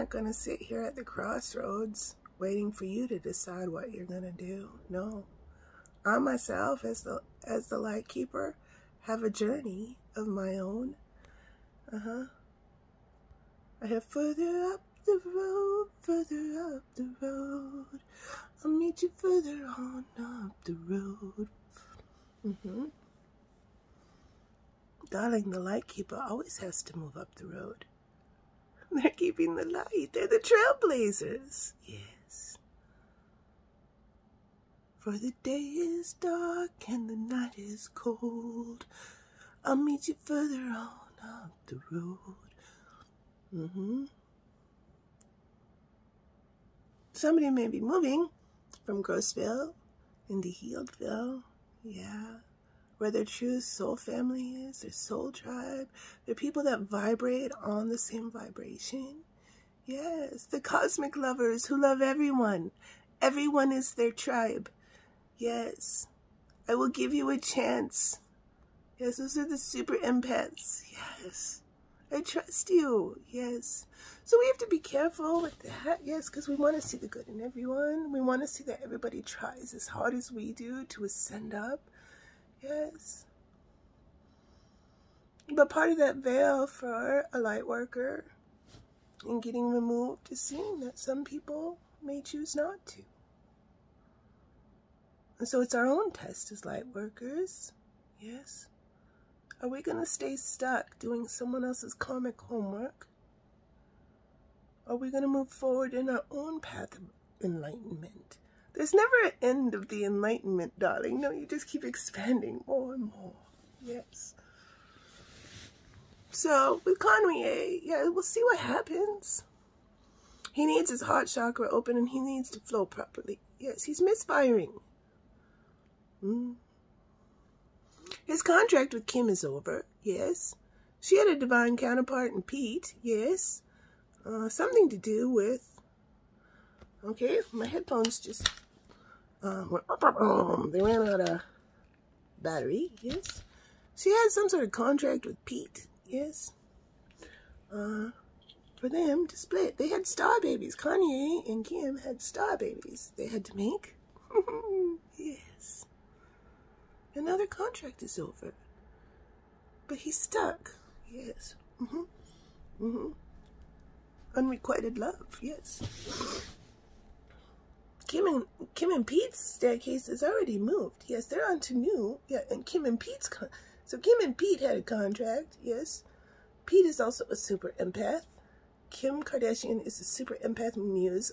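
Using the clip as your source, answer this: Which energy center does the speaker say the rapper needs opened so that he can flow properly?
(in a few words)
heart chakra.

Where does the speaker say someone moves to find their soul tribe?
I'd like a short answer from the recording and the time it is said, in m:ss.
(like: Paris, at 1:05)
Healdville, at 0:50.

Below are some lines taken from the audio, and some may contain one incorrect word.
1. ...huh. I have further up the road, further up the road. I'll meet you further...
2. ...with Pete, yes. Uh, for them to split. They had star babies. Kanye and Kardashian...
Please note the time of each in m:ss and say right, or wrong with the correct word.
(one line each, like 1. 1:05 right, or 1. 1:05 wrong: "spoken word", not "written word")
1. 0:12 right
2. 2:25 wrong: "Kim", not "Kardashian".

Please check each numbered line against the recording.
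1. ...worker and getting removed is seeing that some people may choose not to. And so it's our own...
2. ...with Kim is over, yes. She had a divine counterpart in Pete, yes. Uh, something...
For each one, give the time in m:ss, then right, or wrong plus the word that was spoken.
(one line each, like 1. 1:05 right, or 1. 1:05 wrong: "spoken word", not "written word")
1. 1:27 right
2. 2:08 right.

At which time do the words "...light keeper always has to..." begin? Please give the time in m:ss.
0:25.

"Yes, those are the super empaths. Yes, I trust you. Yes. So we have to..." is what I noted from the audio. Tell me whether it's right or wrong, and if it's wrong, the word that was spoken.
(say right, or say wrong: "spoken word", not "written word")
right.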